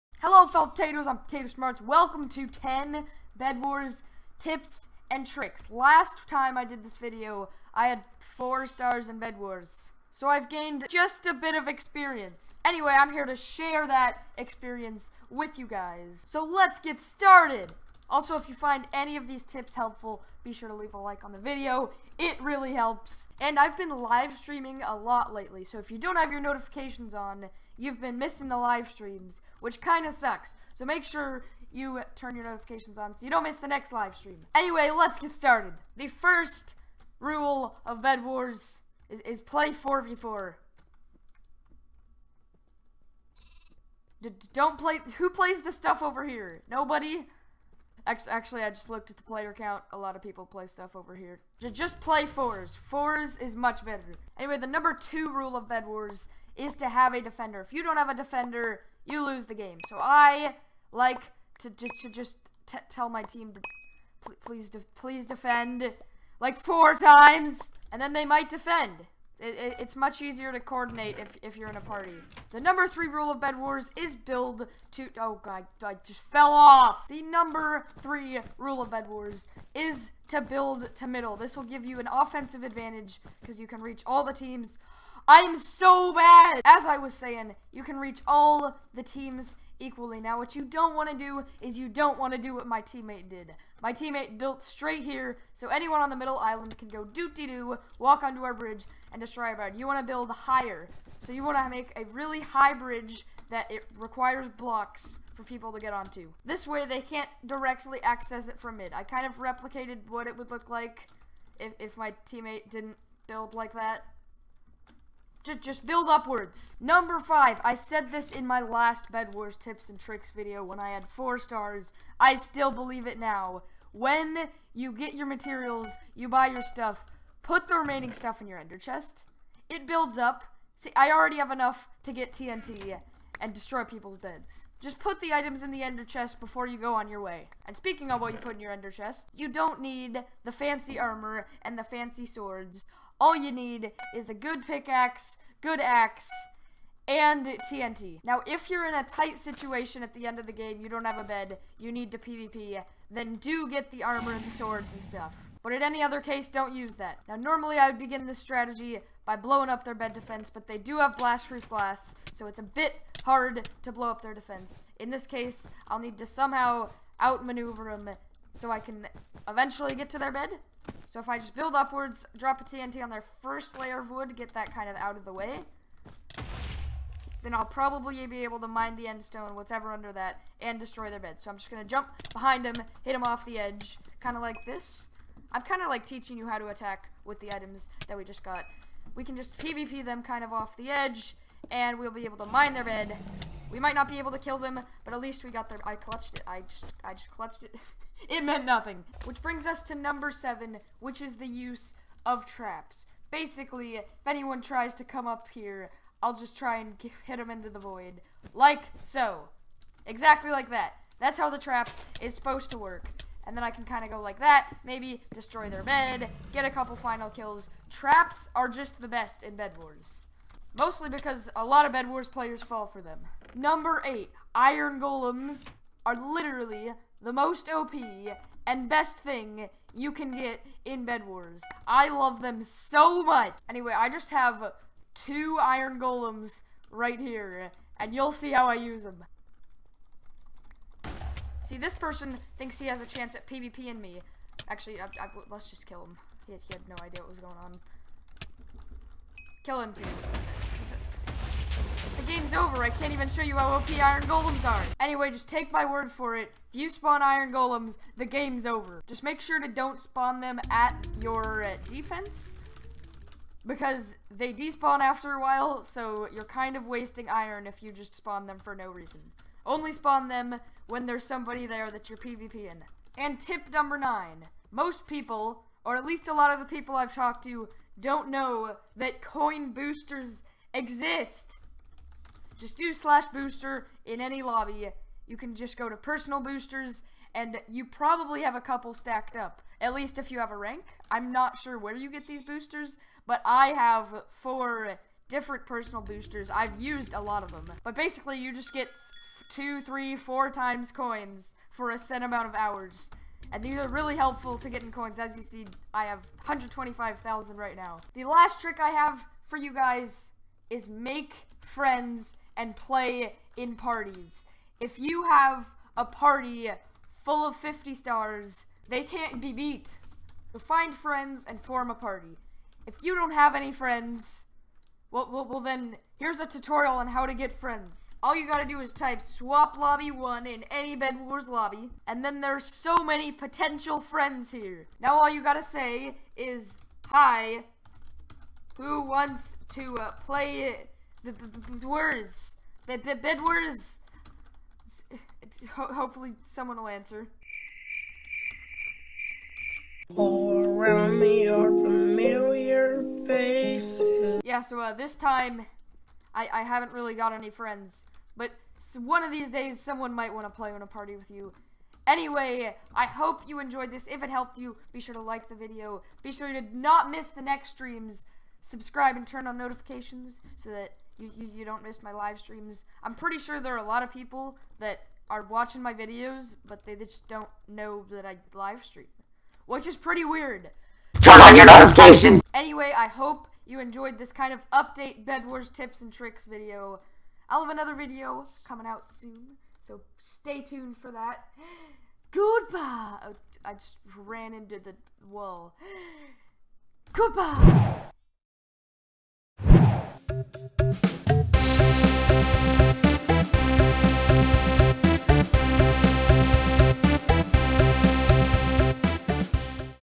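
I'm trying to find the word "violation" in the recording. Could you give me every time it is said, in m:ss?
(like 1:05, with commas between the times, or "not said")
not said.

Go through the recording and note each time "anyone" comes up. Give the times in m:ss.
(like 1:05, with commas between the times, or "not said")
1:35, 3:24.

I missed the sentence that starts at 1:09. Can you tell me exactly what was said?
It, it, it's much easier to coordinate if, if you're in a party.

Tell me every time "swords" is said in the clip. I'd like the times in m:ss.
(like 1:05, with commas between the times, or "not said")
2:22, 2:34.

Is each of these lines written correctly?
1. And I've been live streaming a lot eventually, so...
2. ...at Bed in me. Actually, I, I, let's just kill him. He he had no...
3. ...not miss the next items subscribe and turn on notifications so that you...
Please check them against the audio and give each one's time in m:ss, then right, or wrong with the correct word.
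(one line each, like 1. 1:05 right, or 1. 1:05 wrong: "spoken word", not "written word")
1. 0:23 wrong: "lately", not "eventually"
2. 4:03 wrong: "PvP", not "Bed"
3. 6:06 wrong: "streams", not "items".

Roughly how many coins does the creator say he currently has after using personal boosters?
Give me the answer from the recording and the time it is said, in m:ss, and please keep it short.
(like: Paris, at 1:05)
125,000, at 5:06.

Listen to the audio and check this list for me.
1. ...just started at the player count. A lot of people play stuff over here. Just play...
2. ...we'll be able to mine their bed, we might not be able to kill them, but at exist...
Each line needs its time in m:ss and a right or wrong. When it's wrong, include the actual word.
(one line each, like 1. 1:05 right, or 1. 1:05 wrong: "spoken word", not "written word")
1. 0:48 wrong: "looked", not "started"
2. 3:11 wrong: "least", not "exist".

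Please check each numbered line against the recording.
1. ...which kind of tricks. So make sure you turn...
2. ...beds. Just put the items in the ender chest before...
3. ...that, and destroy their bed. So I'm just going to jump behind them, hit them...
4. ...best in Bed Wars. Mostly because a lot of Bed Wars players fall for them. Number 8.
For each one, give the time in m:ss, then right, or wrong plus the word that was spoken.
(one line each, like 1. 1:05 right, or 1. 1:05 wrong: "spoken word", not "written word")
1. 0:29 wrong: "sucks", not "tricks"
2. 2:14 right
3. 3:00 right
4. 3:39 right.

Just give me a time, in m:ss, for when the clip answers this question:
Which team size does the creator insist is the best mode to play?
0:39.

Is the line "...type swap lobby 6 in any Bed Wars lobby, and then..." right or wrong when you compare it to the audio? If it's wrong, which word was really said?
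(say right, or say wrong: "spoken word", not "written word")
wrong: "1", not "6".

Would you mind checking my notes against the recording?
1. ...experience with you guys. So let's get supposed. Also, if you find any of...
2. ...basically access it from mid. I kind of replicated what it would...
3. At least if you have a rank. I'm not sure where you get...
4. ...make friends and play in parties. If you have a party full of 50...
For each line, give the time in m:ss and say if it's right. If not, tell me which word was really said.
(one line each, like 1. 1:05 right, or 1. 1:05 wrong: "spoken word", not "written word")
1. 0:14 wrong: "started", not "supposed"
2. 1:47 wrong: "directly", not "basically"
3. 4:49 right
4. 5:10 right.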